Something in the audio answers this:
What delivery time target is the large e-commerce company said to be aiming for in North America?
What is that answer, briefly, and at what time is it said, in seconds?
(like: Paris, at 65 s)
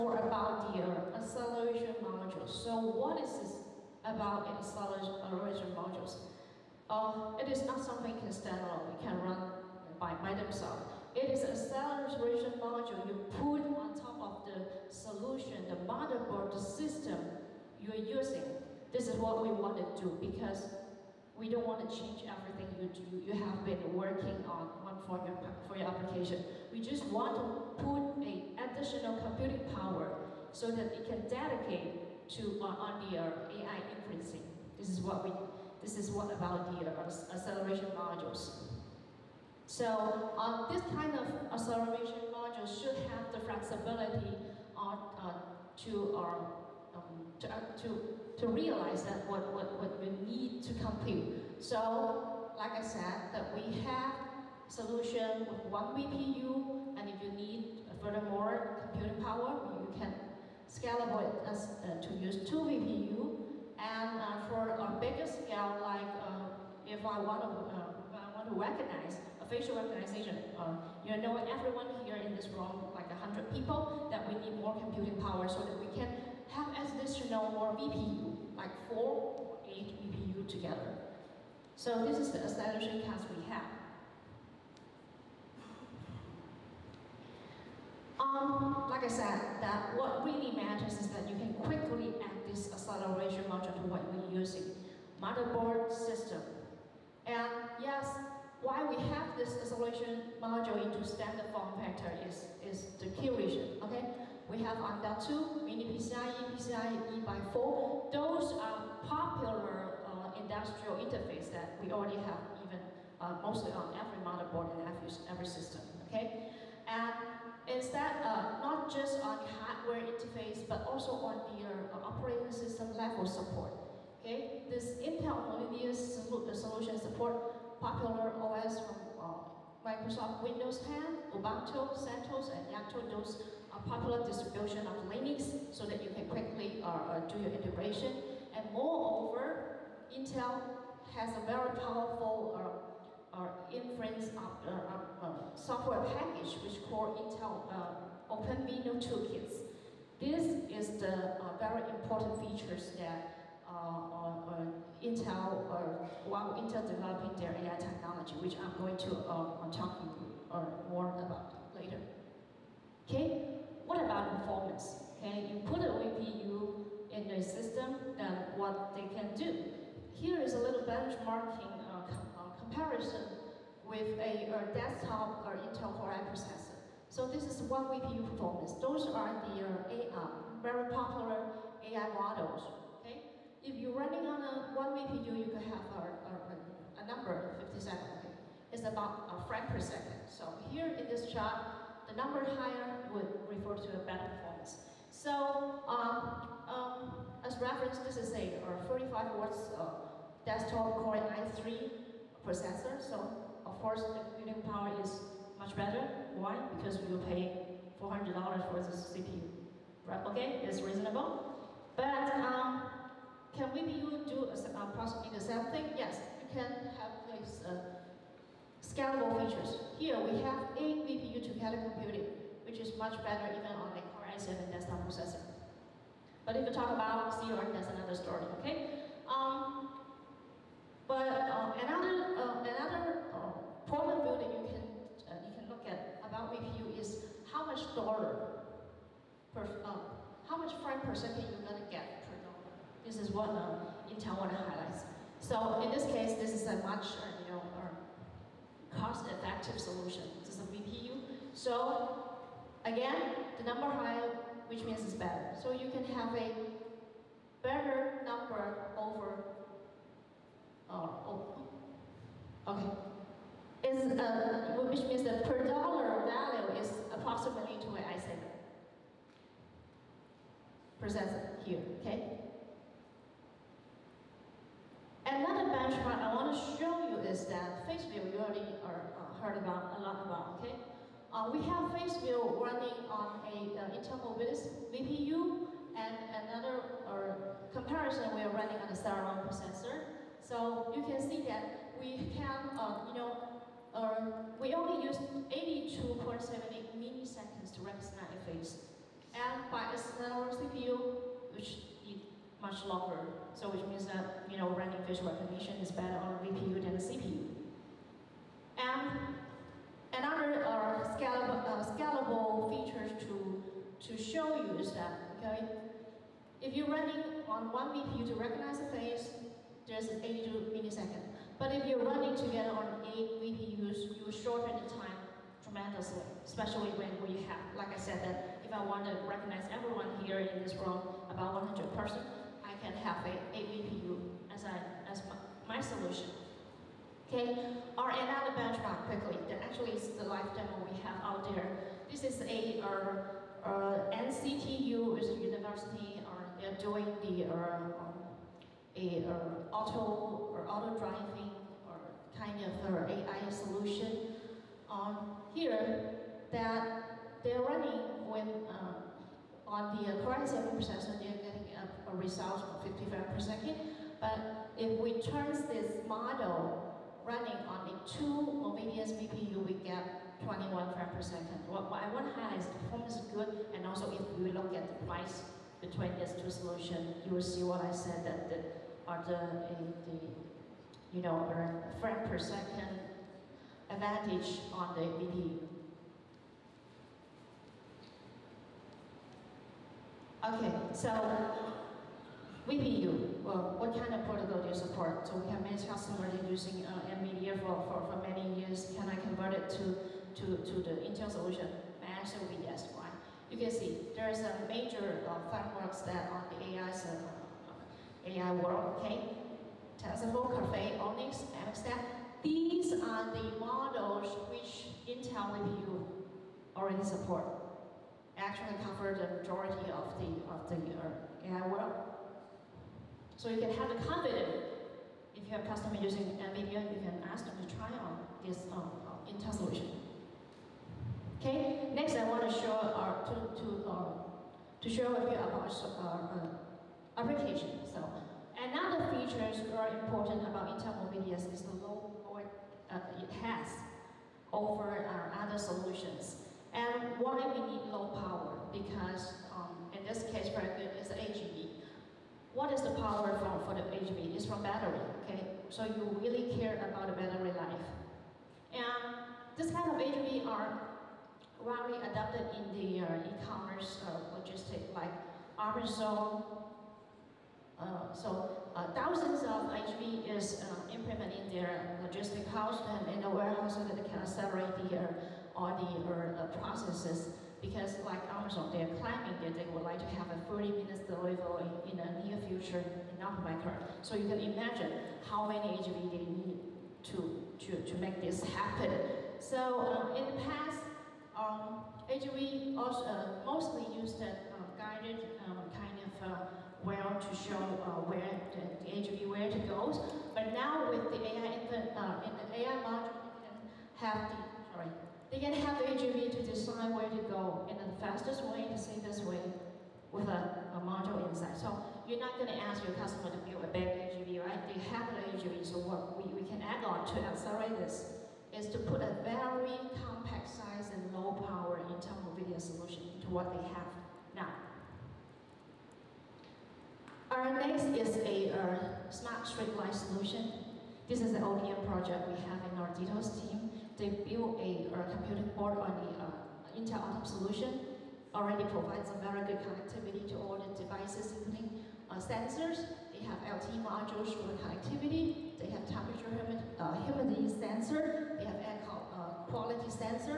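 30 minutes, at 480 s.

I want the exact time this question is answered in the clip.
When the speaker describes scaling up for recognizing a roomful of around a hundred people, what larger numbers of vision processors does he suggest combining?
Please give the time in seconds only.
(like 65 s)
78 s.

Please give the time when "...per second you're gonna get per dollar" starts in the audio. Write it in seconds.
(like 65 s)
240 s.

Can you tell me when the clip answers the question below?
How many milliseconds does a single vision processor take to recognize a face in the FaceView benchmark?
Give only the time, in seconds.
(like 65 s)
295 s.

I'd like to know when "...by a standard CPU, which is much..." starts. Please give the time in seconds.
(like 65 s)
299 s.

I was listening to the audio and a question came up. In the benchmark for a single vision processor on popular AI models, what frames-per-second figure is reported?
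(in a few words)
57.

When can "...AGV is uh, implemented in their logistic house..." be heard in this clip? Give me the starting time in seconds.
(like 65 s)
469 s.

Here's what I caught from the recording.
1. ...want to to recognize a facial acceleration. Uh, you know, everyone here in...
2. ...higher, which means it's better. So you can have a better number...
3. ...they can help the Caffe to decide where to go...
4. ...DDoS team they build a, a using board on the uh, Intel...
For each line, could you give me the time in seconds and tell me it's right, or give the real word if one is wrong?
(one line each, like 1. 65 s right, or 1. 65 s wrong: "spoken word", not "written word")
1. 67 s wrong: "recognition", not "acceleration"
2. 253 s right
3. 505 s wrong: "AGV", not "Caffe"
4. 532 s wrong: "computing", not "using".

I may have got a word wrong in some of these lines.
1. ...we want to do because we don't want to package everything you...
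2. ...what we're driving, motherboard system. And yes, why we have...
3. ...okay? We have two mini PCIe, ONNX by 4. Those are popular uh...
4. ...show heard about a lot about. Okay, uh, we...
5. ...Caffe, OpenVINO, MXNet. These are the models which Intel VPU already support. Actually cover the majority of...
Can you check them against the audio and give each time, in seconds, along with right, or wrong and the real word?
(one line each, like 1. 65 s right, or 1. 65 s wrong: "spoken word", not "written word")
1. 19 s wrong: "change", not "package"
2. 93 s wrong: "using", not "driving"
3. 103 s wrong: "PCIe", not "ONNX"
4. 276 s right
5. 410 s wrong: "ONNX", not "OpenVINO".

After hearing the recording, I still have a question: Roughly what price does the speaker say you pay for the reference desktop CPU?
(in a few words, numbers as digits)
$400.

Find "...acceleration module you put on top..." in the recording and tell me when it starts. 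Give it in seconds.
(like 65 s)
11 s.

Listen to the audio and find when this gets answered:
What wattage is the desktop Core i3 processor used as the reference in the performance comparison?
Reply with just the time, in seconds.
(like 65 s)
198 s.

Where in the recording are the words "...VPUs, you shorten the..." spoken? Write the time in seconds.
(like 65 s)
323 s.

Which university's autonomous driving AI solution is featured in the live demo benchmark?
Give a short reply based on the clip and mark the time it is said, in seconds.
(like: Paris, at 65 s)
NCTU, at 344 s.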